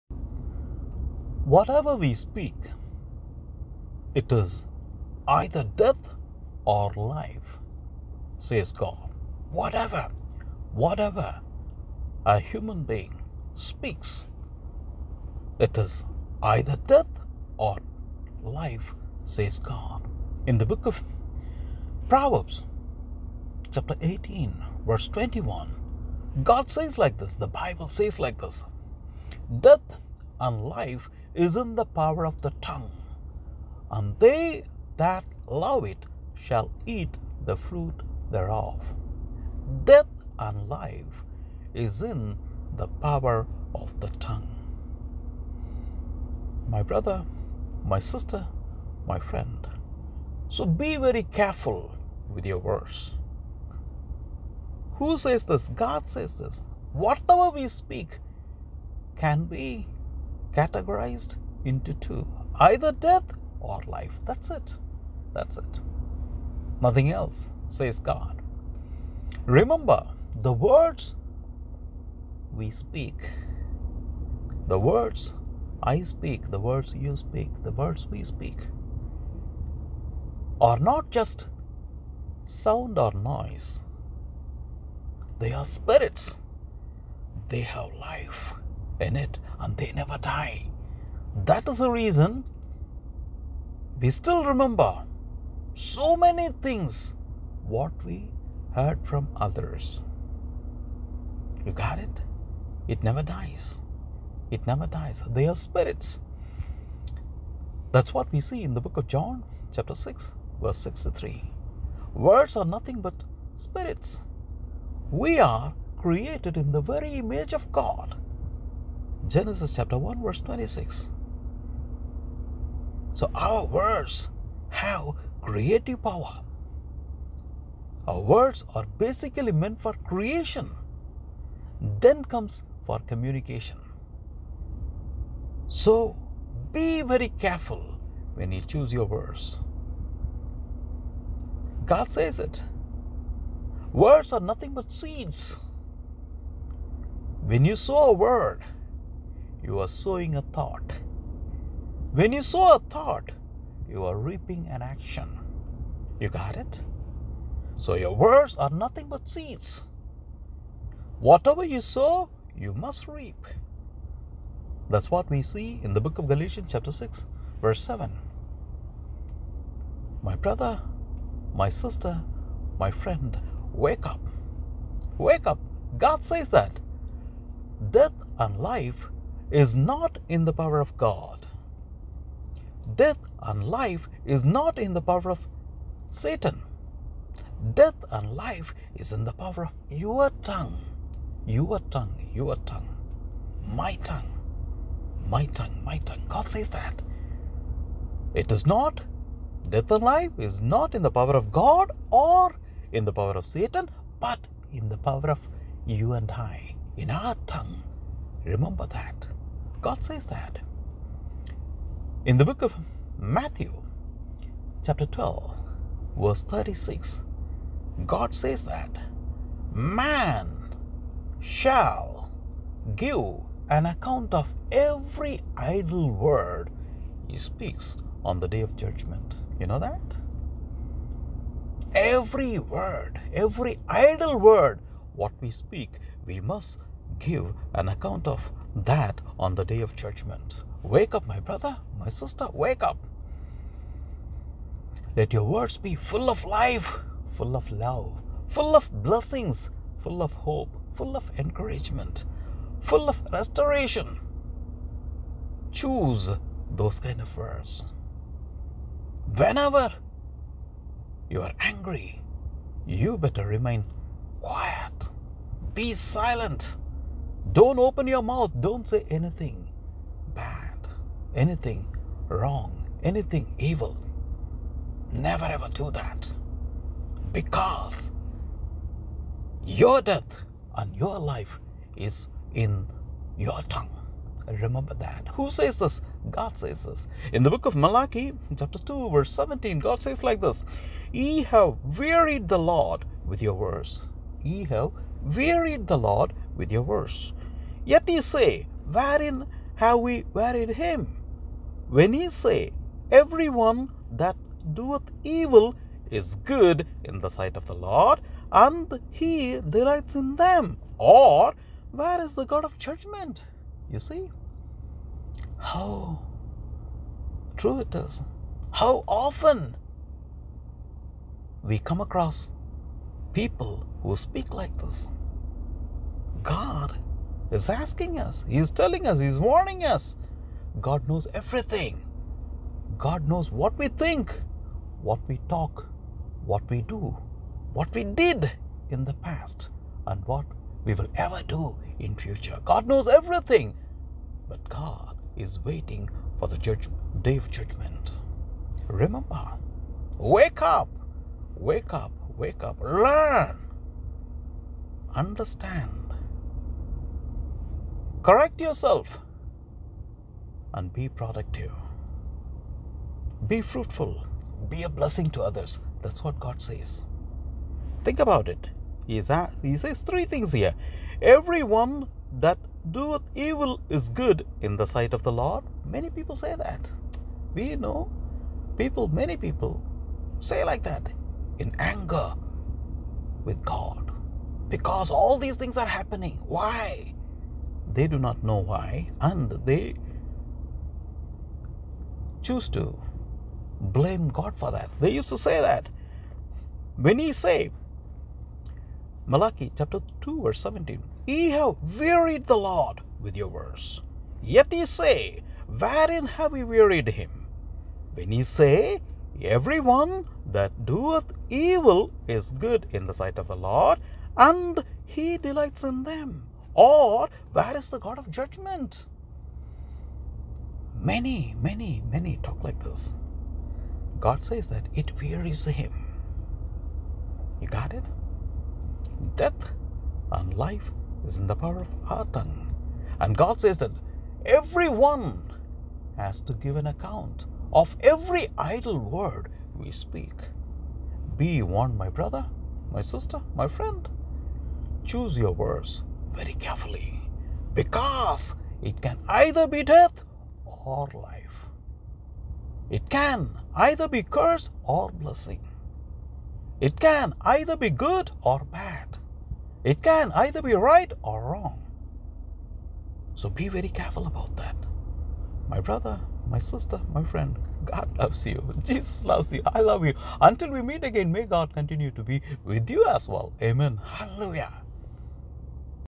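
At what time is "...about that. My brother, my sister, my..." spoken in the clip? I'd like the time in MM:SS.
07:44.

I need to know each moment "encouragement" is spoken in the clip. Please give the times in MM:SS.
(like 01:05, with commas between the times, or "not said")
04:11.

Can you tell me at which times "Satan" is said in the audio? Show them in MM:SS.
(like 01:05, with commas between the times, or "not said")
03:06, 03:23.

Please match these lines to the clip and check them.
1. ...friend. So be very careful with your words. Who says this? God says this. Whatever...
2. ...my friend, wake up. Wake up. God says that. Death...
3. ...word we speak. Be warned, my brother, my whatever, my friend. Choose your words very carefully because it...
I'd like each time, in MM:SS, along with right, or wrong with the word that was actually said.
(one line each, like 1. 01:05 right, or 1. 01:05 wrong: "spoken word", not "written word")
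1. 00:49 right
2. 02:52 right
3. 07:18 wrong: "sister", not "whatever".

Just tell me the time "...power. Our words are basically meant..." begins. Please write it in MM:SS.
02:06.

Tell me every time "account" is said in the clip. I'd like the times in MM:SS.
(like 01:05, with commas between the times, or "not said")
03:43, 03:57, 07:16.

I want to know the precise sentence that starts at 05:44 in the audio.
But God is waiting for the judge, day of judgment.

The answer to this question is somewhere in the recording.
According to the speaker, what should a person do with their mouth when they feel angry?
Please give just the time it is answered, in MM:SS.
04:23.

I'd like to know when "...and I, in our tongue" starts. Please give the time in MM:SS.
03:26.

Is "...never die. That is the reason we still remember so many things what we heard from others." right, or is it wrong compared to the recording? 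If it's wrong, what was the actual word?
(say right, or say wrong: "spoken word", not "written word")
right.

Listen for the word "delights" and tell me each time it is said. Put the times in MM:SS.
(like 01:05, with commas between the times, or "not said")
05:09, 06:55.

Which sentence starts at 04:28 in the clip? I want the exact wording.
Don't say anything bad, anything wrong, anything evil.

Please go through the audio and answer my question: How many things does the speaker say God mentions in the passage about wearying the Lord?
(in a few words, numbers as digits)
3.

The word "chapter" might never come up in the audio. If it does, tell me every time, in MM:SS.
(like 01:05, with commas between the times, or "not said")
00:23, 01:49, 01:59, 02:46, 03:34, 04:48, 06:39.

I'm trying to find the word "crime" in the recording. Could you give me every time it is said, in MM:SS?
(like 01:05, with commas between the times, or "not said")
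not said.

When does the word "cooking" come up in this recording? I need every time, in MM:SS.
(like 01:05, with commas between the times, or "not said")
not said.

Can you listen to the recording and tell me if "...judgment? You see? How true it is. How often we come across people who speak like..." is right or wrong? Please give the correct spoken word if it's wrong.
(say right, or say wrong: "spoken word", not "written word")
right.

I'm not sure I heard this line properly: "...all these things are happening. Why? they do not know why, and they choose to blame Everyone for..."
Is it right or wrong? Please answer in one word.
wrong.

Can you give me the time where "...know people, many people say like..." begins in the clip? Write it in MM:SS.
06:17.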